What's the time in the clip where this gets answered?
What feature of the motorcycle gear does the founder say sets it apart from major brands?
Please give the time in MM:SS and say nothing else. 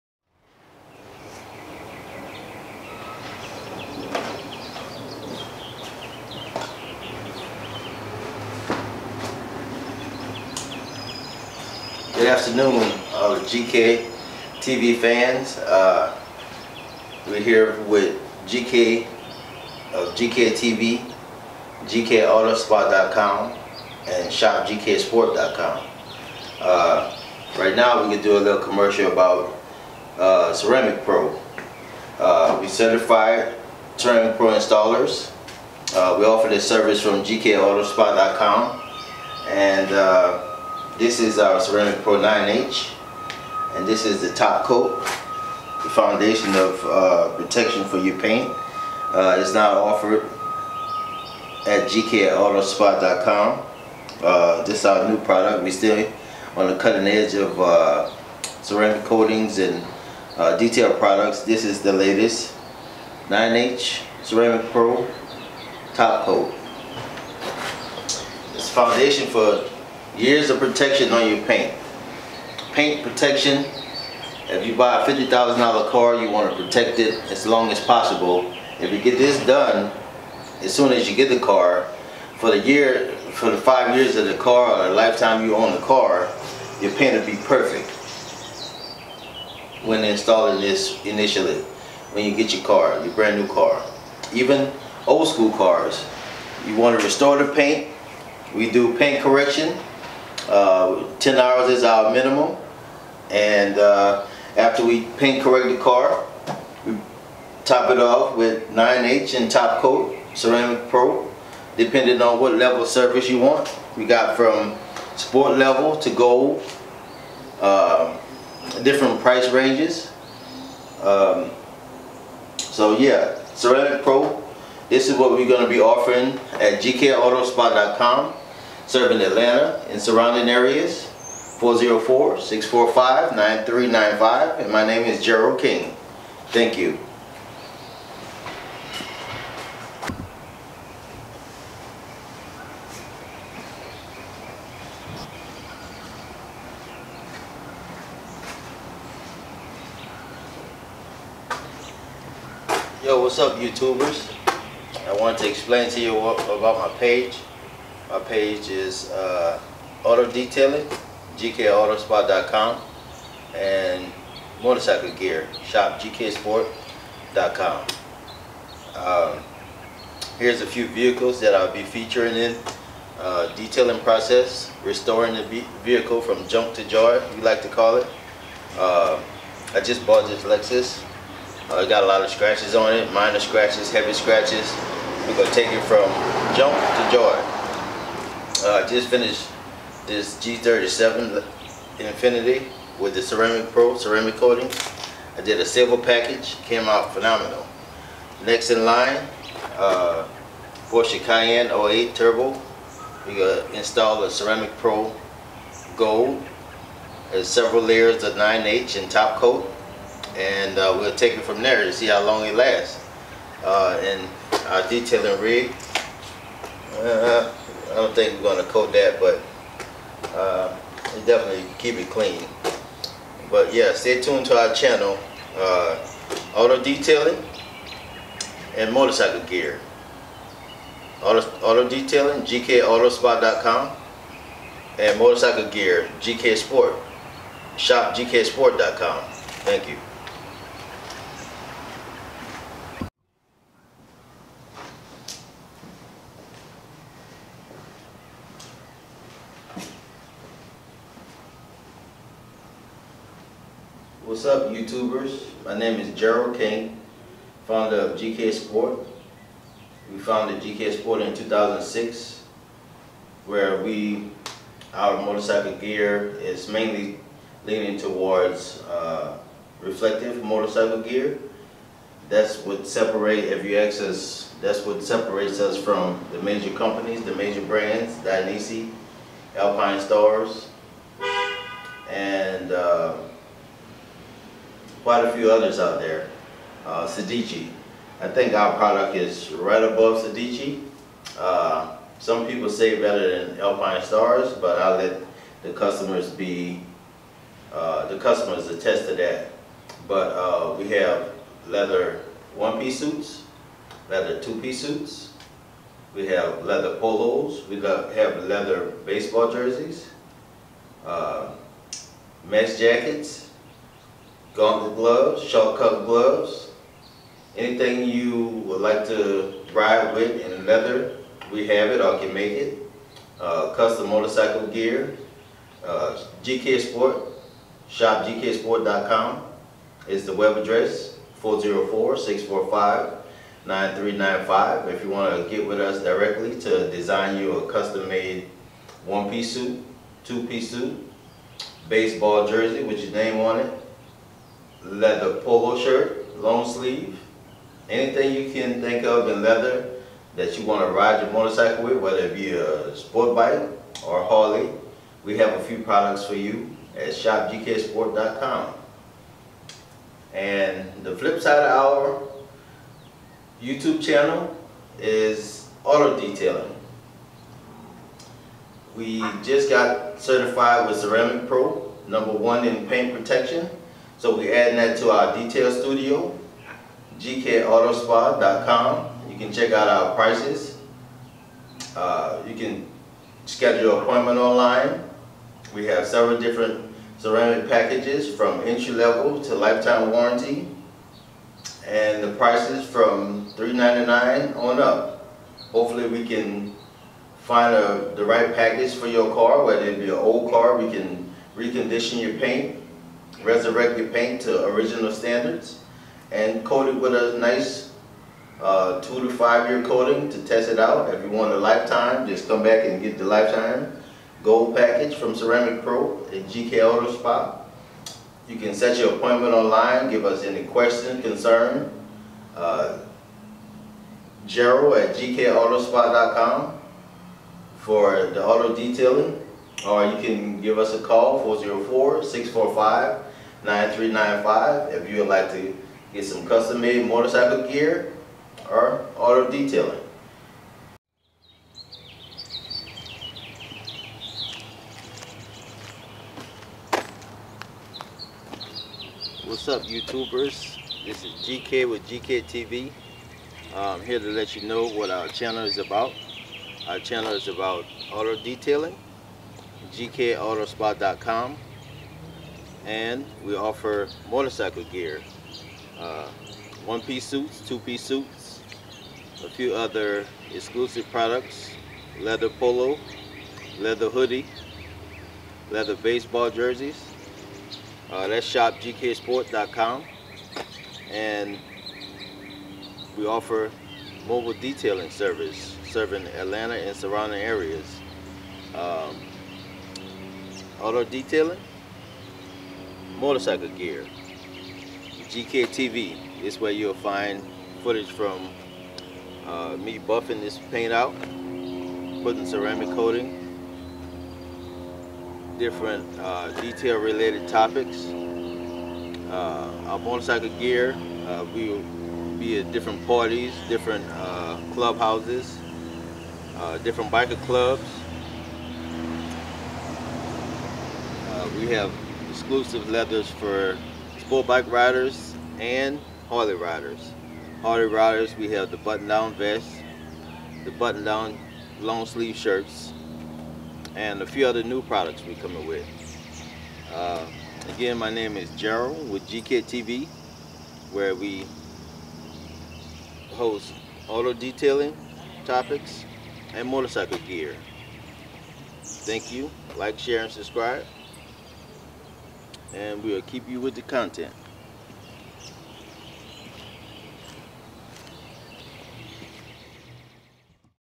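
04:29.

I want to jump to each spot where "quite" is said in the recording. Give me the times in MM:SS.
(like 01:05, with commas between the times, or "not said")
04:45.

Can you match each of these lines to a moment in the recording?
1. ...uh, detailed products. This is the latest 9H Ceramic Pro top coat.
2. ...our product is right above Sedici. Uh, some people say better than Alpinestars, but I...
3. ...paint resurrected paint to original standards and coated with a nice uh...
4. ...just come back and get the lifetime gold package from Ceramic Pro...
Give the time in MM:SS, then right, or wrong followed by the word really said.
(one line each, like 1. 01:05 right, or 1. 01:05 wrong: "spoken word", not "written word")
1. 01:00 right
2. 04:48 right
3. 06:42 right
4. 06:52 right.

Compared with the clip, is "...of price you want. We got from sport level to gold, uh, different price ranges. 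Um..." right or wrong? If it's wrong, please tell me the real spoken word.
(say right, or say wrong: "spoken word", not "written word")
wrong: "surface", not "price".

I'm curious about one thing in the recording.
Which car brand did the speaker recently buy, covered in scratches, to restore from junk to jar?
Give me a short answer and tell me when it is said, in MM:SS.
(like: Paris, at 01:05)
Lexus, at 03:00.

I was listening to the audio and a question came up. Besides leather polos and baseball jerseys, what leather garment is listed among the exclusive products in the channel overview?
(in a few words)
leather hoodie.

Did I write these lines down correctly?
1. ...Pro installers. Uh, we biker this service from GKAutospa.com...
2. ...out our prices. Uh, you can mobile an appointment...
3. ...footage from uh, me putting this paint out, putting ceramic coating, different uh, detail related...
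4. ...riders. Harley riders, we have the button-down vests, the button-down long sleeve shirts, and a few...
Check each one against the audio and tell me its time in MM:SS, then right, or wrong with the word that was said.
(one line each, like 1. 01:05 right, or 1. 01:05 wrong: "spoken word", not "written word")
1. 00:34 wrong: "offer", not "biker"
2. 06:19 wrong: "schedule", not "mobile"
3. 08:17 wrong: "buffing", not "putting"
4. 08:46 right.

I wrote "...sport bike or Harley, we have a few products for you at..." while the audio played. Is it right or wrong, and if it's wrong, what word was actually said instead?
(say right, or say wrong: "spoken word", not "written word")
right.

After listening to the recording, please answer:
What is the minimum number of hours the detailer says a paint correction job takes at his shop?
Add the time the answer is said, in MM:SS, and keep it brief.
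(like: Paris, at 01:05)
10 hours, at 01:41.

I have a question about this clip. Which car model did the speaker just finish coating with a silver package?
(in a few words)
G37 Infiniti.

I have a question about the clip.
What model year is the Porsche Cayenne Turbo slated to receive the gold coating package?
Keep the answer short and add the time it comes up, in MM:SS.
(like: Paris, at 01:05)
2008, at 03:21.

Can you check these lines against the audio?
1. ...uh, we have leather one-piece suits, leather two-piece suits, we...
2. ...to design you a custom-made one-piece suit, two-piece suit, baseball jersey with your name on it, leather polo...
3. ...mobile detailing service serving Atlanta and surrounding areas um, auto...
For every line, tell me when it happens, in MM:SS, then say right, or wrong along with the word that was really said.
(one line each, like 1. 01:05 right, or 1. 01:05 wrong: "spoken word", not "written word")
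1. 05:00 right
2. 05:36 right
3. 08:04 right.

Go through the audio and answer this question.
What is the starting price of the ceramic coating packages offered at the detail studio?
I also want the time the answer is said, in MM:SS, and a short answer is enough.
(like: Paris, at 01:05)
$399, at 06:33.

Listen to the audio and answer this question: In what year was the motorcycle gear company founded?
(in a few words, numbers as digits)
2006.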